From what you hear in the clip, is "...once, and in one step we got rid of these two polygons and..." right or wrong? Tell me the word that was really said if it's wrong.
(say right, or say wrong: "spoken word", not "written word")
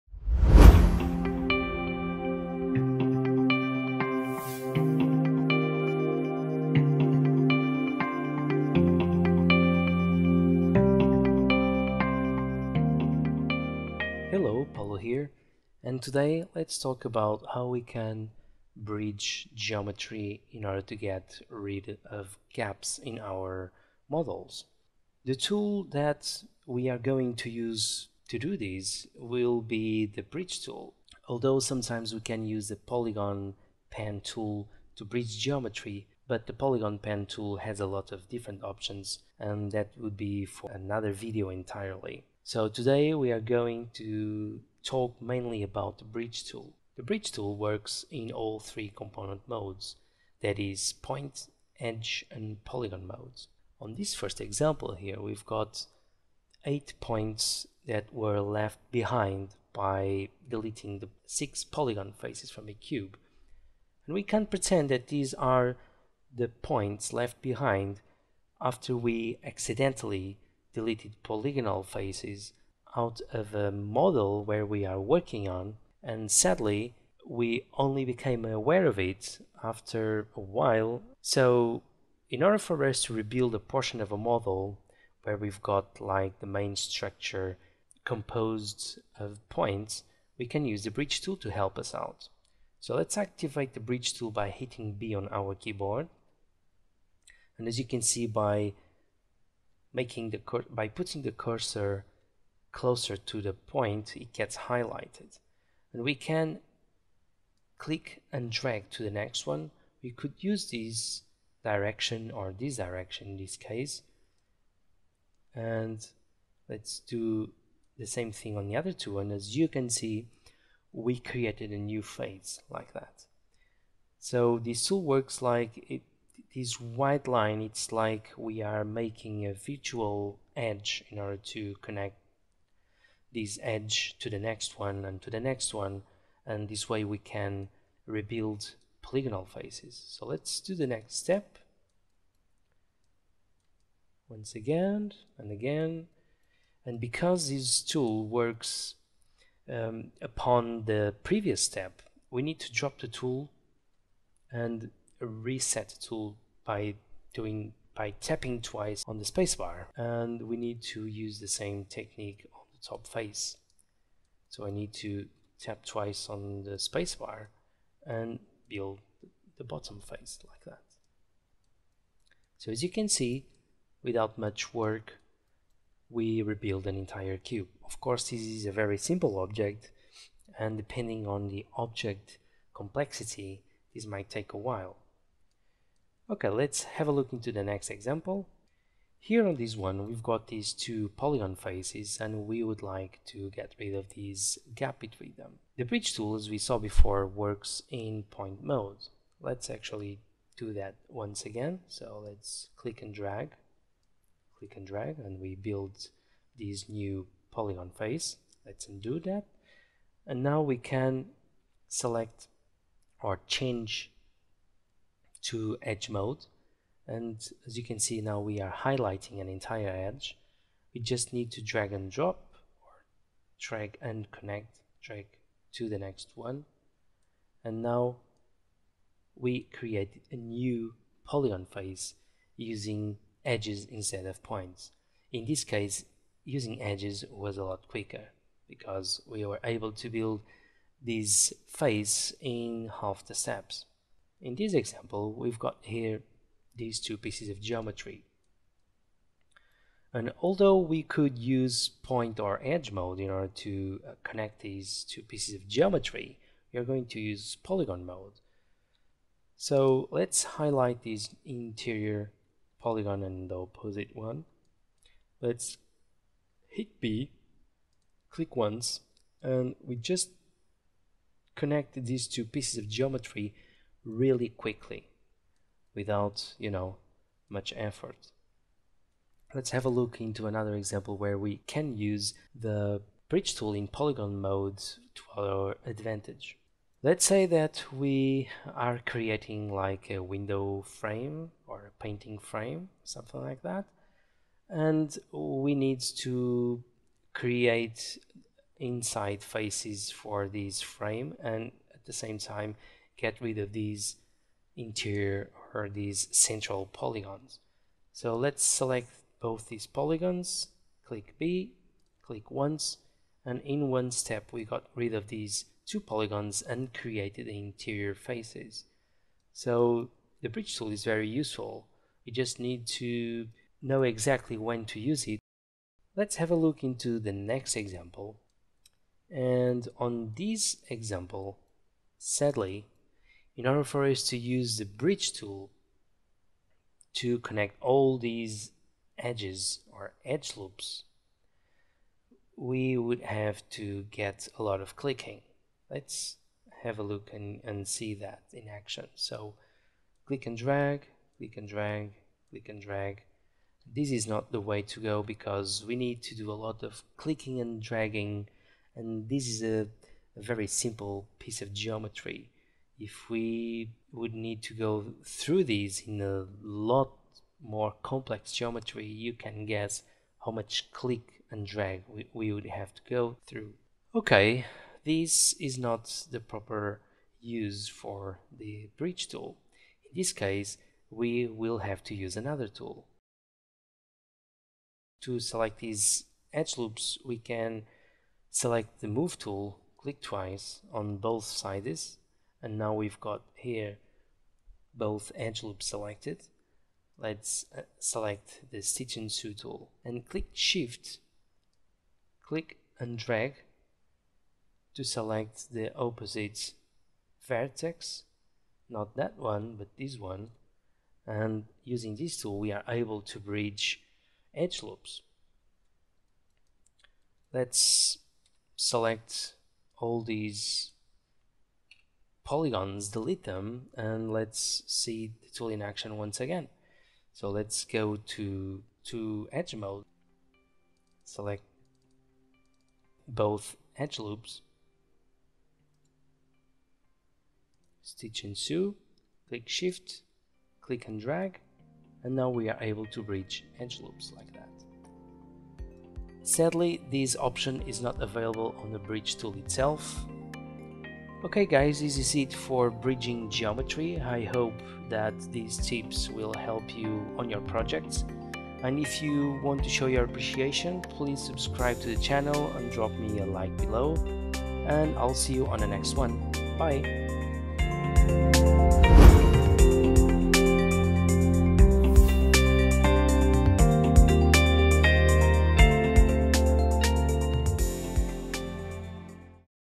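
right.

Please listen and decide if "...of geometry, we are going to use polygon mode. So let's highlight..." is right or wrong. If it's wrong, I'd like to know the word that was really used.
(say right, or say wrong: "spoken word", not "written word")
right.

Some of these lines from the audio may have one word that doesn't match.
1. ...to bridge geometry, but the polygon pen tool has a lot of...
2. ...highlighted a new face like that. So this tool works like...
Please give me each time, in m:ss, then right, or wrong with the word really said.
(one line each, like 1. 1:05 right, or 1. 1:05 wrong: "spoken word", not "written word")
1. 0:34 right
2. 2:01 wrong: "created", not "highlighted".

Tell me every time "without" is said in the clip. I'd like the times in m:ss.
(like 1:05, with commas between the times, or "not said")
2:54, 4:35.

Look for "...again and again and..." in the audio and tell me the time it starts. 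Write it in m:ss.
2:24.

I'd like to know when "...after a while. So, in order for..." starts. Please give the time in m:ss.
1:19.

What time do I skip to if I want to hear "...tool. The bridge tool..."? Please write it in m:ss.
0:46.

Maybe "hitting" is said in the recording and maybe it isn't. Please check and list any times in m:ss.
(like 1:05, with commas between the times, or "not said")
1:34.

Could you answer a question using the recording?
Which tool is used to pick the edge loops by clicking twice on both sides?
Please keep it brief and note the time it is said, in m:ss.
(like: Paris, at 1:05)
Move tool, at 6:29.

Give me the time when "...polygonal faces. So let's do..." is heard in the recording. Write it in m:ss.
2:19.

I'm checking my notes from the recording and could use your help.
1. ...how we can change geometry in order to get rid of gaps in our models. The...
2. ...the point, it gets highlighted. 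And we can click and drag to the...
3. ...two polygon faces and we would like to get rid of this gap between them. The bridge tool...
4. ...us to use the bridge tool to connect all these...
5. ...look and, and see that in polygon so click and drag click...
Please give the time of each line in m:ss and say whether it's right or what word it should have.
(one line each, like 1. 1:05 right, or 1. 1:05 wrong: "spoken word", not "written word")
1. 0:17 wrong: "bridge", not "change"
2. 1:43 right
3. 3:10 right
4. 5:34 right
5. 5:47 wrong: "action", not "polygon".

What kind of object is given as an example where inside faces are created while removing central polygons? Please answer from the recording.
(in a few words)
Window frame.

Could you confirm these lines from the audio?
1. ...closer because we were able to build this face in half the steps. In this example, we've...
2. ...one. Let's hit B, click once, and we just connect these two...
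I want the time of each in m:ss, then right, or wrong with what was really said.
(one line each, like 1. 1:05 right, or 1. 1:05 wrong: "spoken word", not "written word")
1. 3:57 wrong: "quicker", not "closer"
2. 4:24 right.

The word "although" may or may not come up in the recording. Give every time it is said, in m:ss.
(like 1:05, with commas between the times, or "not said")
0:31, 4:10.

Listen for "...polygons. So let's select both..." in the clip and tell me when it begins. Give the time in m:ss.
5:06.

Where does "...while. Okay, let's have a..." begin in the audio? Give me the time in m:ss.
3:04.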